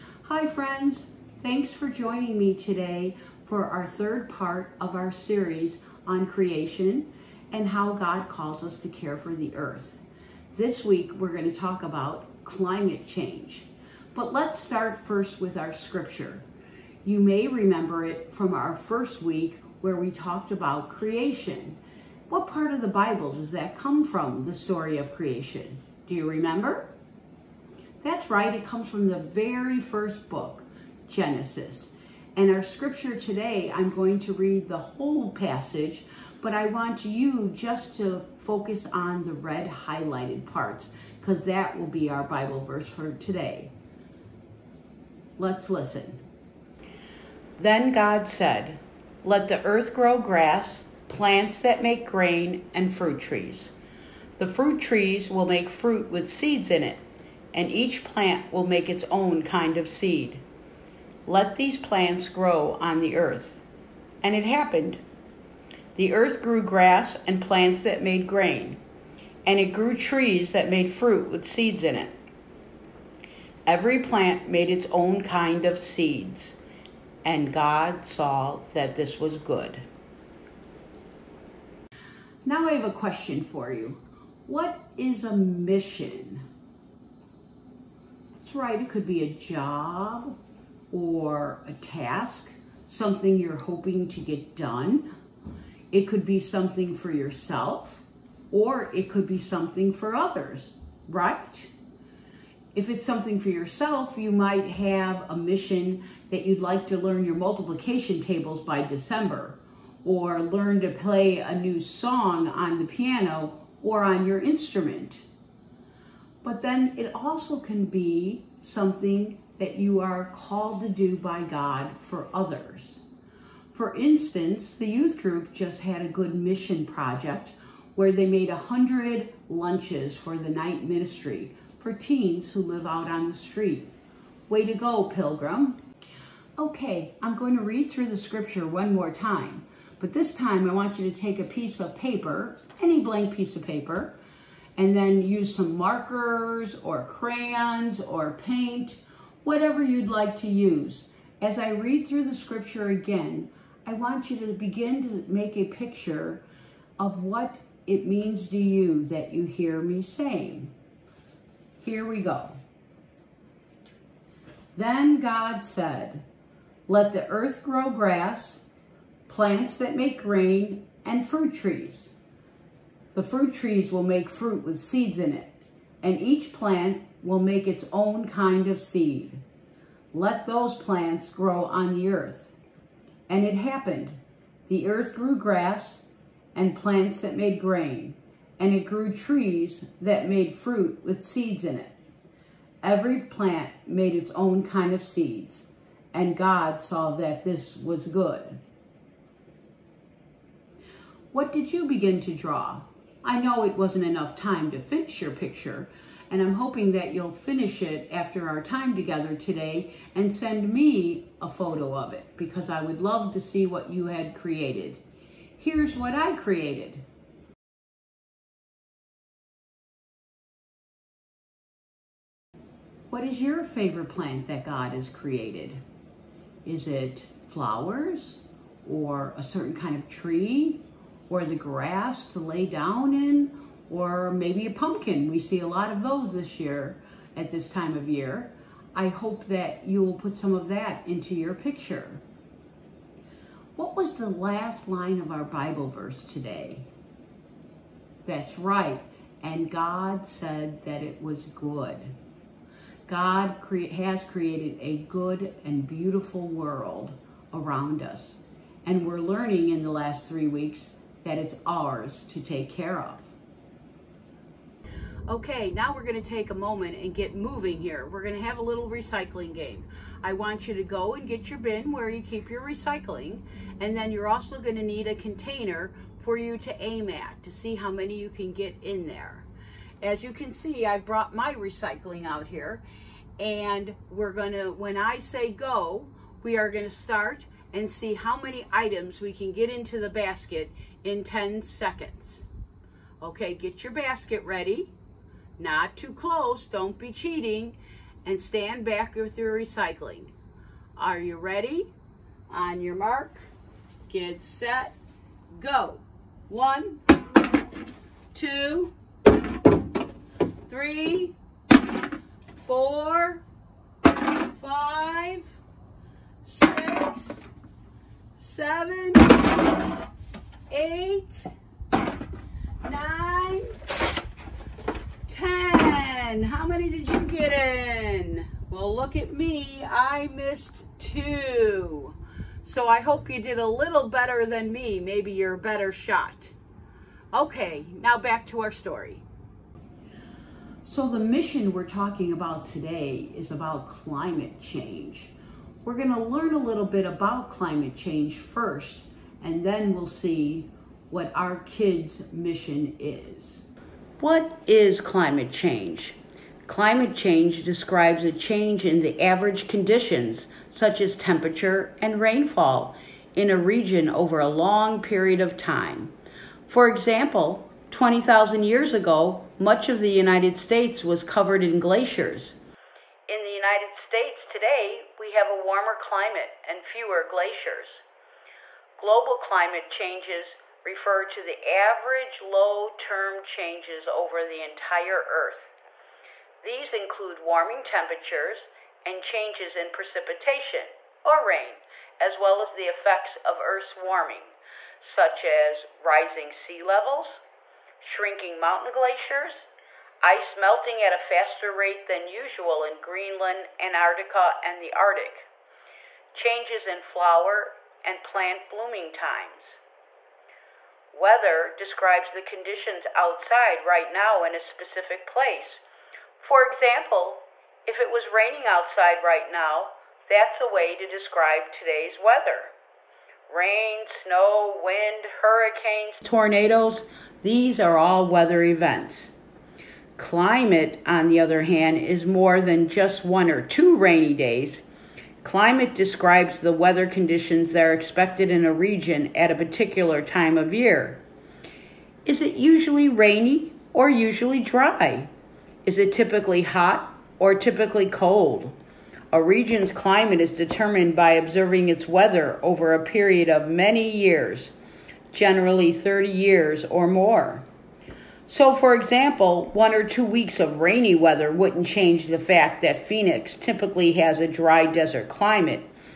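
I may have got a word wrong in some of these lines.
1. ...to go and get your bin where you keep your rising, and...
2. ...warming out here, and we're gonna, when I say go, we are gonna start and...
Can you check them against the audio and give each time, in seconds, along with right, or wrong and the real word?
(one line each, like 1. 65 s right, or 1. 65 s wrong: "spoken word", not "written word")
1. 270 s wrong: "recycling", not "rising"
2. 281 s wrong: "recycling", not "warming".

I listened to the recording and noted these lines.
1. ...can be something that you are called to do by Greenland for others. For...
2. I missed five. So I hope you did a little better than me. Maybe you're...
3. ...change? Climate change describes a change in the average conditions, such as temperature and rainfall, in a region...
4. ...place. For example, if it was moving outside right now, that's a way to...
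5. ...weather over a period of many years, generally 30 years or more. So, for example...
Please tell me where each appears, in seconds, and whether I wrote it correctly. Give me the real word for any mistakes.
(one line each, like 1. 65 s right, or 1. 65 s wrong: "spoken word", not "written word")
1. 117 s wrong: "God", not "Greenland"
2. 329 s wrong: "two", not "five"
3. 355 s right
4. 415 s wrong: "raining", not "moving"
5. 452 s right.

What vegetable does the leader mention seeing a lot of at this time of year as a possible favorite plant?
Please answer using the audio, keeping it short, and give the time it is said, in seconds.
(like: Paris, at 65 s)
pumpkin, at 234 s.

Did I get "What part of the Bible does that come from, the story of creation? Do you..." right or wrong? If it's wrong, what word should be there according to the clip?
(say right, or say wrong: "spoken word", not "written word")
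right.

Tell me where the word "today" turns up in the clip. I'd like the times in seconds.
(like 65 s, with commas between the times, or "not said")
2 s, 33 s, 43 s, 209 s, 246 s, 342 s, 374 s, 421 s.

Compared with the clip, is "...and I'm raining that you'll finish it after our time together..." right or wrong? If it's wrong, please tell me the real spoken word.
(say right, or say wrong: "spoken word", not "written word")
wrong: "hoping", not "raining".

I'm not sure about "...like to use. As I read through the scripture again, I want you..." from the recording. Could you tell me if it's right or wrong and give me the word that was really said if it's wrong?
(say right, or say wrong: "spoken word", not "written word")
right.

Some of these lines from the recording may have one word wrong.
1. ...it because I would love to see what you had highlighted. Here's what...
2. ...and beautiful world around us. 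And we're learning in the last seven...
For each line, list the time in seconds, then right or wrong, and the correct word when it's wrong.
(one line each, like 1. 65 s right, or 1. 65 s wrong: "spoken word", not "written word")
1. 212 s wrong: "created", not "highlighted"
2. 255 s wrong: "three", not "seven".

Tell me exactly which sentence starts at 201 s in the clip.
What did you begin to draw?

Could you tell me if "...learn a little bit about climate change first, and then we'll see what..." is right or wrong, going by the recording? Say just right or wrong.
right.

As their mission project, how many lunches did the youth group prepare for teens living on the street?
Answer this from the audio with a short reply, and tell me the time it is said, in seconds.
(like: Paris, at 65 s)
100, at 128 s.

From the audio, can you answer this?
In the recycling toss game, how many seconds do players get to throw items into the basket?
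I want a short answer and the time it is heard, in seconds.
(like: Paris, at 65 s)
10, at 291 s.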